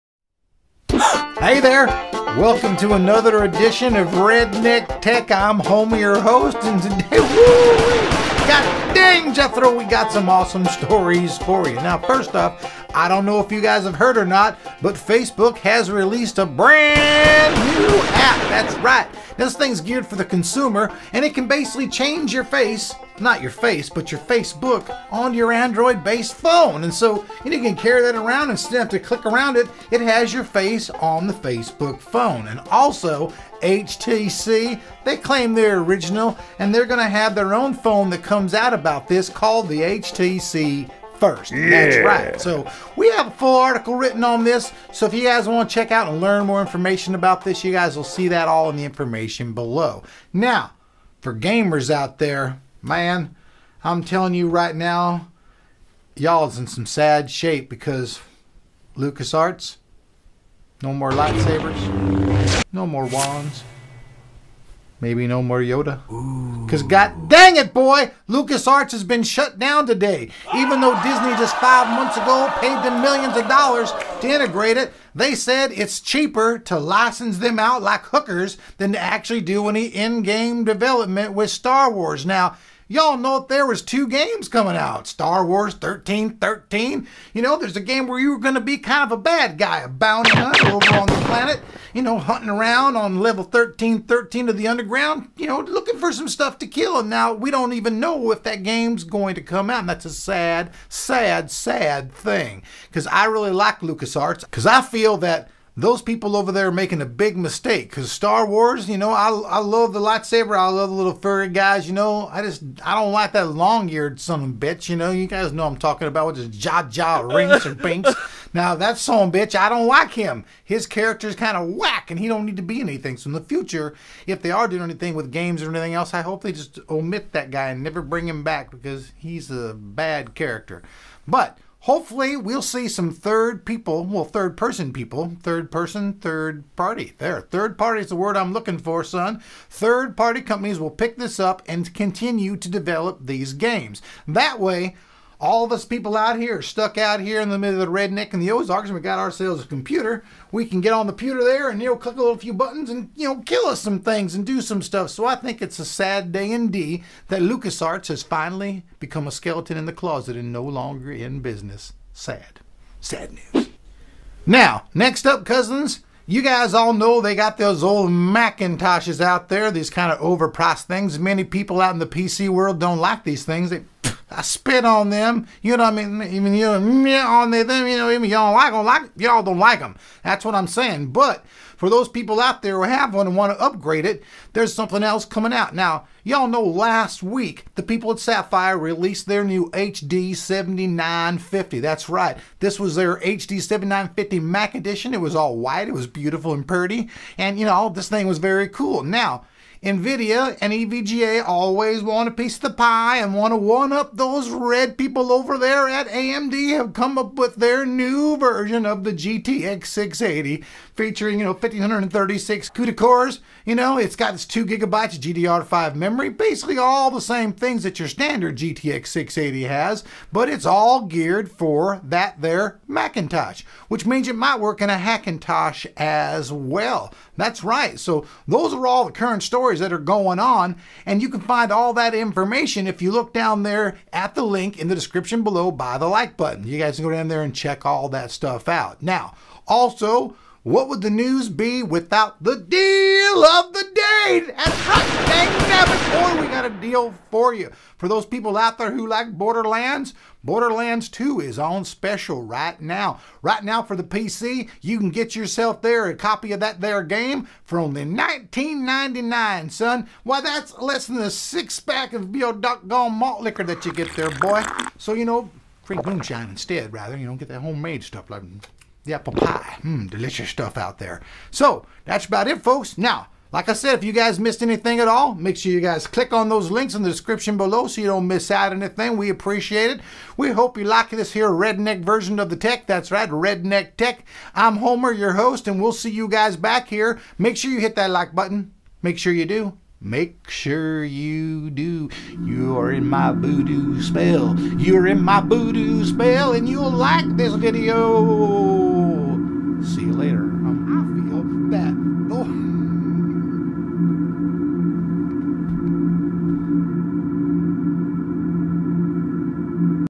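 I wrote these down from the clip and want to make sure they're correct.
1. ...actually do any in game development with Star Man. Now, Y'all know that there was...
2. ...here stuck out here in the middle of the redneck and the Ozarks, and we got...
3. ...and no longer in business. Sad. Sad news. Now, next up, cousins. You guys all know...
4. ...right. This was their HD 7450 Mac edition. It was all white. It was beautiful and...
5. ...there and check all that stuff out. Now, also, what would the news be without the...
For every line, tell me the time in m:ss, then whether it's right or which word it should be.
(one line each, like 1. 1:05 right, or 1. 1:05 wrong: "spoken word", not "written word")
1. 1:18 wrong: "Wars", not "Man"
2. 2:26 right
3. 2:40 right
4. 3:12 wrong: "7950", not "7450"
5. 3:57 right.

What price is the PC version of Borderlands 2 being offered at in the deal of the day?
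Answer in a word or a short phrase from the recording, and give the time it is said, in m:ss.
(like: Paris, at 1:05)
$19.99, at 4:18.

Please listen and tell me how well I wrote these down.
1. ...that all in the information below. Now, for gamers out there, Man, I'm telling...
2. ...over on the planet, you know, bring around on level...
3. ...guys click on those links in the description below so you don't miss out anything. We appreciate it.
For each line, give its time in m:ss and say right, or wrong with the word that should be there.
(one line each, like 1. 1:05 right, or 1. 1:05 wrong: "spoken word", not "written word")
1. 0:48 right
2. 1:30 wrong: "hunting", not "bring"
3. 4:35 right.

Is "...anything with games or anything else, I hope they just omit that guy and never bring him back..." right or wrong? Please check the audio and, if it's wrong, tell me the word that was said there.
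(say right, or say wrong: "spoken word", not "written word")
right.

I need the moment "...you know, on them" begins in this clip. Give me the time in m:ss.
2:56.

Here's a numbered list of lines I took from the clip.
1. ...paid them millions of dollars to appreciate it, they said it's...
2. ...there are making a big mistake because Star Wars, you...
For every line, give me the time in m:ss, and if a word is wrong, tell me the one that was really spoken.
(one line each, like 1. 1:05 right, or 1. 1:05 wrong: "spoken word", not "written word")
1. 1:12 wrong: "integrate", not "appreciate"
2. 1:46 right.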